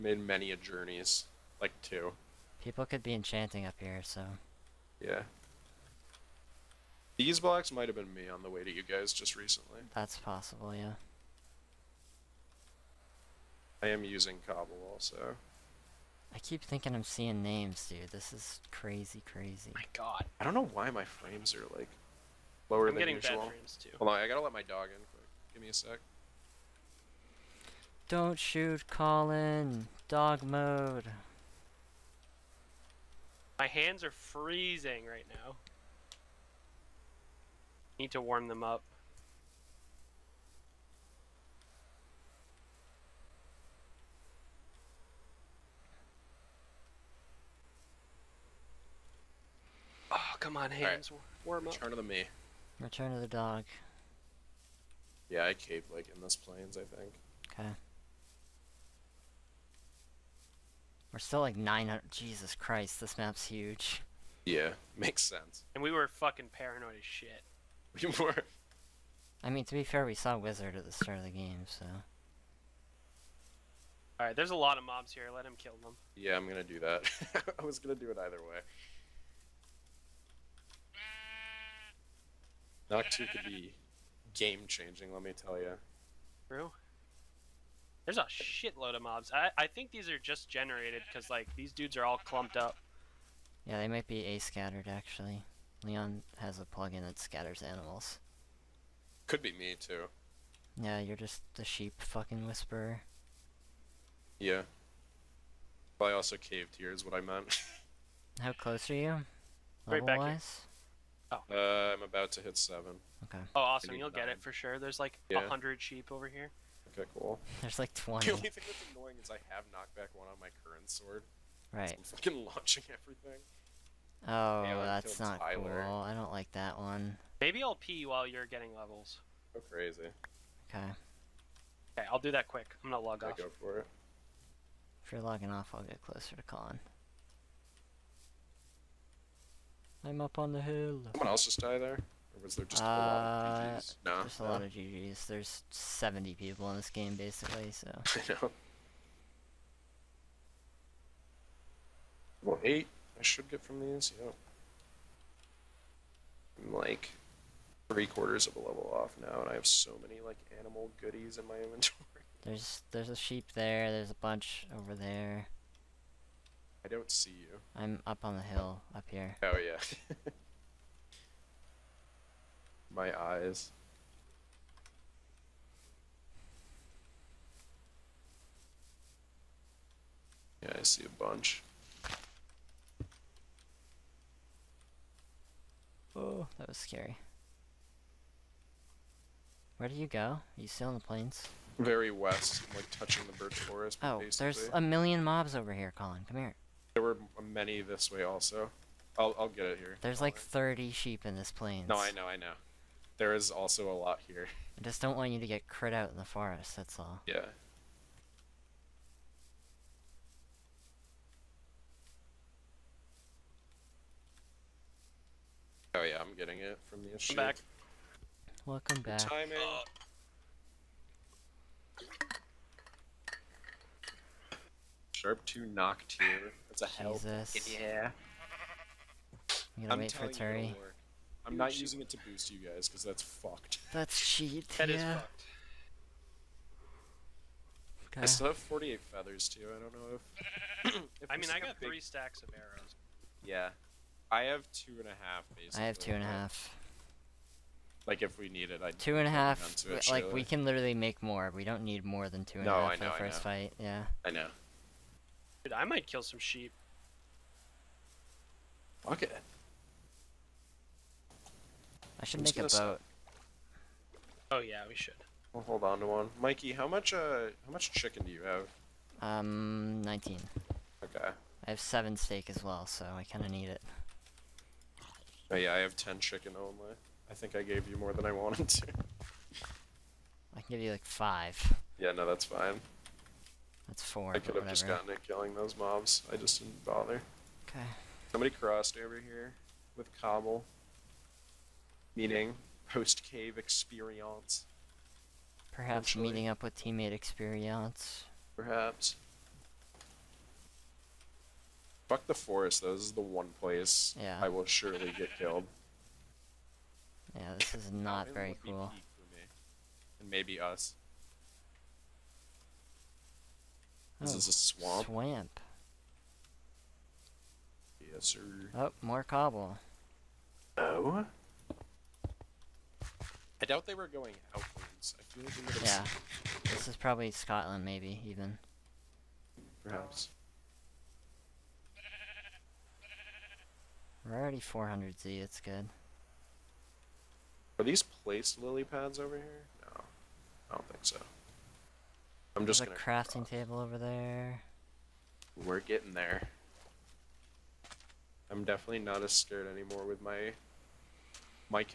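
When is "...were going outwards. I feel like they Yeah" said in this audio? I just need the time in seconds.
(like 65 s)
323 s.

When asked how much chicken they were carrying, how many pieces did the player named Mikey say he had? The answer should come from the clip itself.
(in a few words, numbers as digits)
19.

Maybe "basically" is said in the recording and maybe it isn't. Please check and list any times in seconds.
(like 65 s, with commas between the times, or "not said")
147 s, 194 s, 245 s.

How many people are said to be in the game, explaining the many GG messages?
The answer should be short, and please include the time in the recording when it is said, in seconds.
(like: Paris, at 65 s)
70, at 145 s.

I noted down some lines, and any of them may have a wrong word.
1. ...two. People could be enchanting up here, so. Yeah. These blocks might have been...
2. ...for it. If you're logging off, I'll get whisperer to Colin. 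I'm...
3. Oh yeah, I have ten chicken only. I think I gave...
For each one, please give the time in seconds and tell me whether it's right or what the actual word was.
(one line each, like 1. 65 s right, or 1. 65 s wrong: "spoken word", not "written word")
1. 1 s right
2. 133 s wrong: "closer", not "whisperer"
3. 275 s right.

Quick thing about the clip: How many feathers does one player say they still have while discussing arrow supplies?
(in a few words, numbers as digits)
48.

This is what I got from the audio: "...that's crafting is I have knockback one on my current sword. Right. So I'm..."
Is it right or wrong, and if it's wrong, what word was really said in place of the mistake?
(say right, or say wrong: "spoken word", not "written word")
wrong: "annoying", not "crafting".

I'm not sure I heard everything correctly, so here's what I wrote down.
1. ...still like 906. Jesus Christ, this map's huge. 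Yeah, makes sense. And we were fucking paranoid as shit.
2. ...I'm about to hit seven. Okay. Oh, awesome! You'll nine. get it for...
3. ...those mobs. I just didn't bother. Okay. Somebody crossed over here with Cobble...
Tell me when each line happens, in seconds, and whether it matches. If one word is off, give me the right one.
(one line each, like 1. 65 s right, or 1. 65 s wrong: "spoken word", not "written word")
1. 61 s wrong: "900", not "906"
2. 111 s right
3. 285 s right.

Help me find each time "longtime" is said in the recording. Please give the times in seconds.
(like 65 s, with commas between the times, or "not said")
not said.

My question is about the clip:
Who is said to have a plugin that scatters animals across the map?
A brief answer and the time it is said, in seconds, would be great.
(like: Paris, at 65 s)
Leon, at 95 s.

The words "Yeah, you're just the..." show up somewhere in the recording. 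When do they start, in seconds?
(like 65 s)
100 s.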